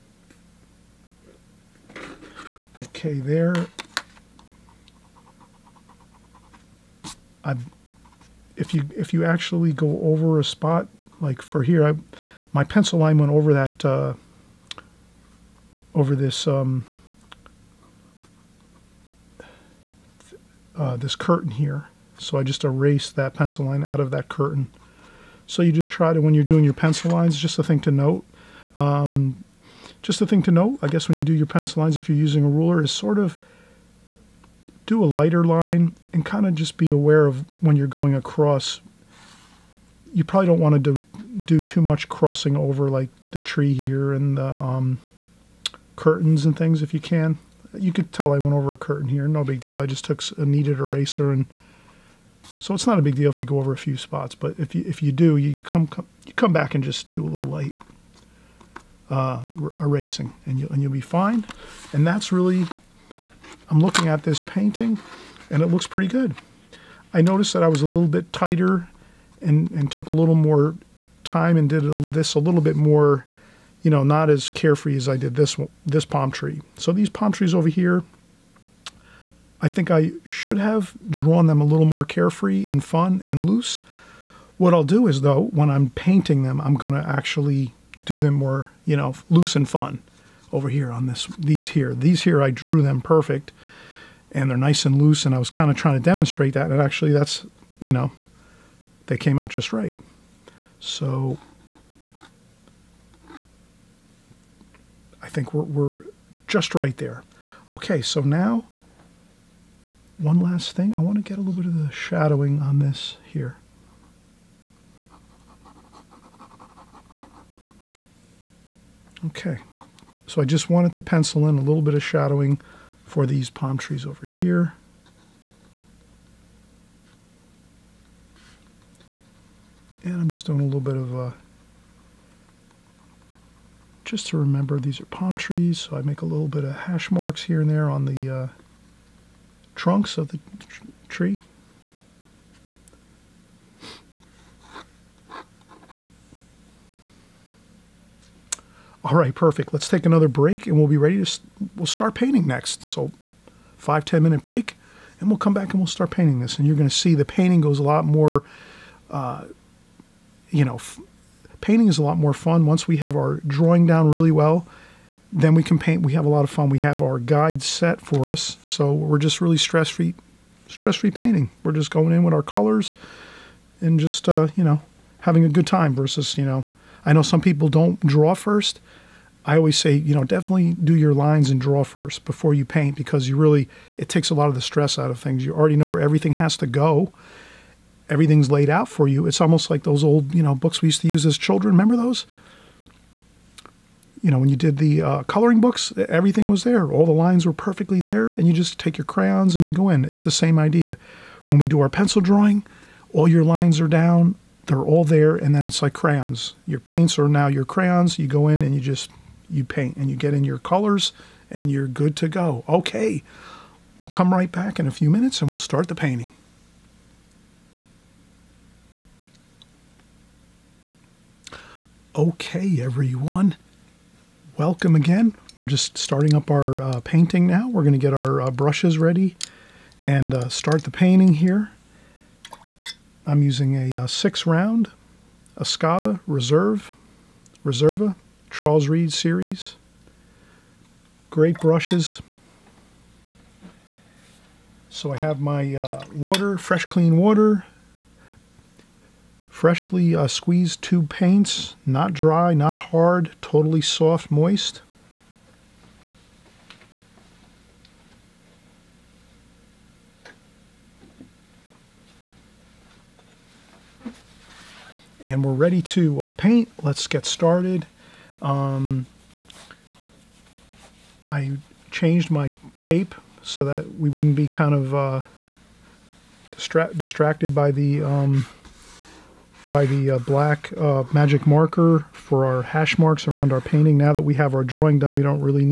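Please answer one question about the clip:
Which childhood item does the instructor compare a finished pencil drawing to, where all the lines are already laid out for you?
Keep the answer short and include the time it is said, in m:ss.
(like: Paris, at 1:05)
coloring books, at 3:15.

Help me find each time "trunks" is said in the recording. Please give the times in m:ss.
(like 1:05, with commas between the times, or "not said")
2:19.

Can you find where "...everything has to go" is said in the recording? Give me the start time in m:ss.
3:06.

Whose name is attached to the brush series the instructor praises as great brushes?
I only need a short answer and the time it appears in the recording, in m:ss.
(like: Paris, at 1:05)
Charles Reid, at 3:58.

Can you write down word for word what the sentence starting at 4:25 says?
and we're ready to uh, paint.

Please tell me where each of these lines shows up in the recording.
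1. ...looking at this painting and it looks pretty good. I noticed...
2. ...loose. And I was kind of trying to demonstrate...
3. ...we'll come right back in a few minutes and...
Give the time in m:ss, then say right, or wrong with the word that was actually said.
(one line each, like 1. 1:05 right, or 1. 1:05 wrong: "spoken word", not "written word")
1. 1:03 right
2. 1:35 right
3. 3:34 right.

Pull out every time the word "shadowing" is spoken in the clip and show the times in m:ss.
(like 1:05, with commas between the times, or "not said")
1:51, 2:02.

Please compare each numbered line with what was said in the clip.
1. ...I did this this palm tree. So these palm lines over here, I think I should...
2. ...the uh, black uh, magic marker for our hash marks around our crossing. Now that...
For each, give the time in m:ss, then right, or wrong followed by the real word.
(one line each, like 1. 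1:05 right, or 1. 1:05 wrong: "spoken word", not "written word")
1. 1:15 wrong: "trees", not "lines"
2. 4:39 wrong: "painting", not "crossing".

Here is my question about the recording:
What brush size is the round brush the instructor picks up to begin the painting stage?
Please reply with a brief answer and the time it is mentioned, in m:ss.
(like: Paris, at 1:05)
6, at 3:54.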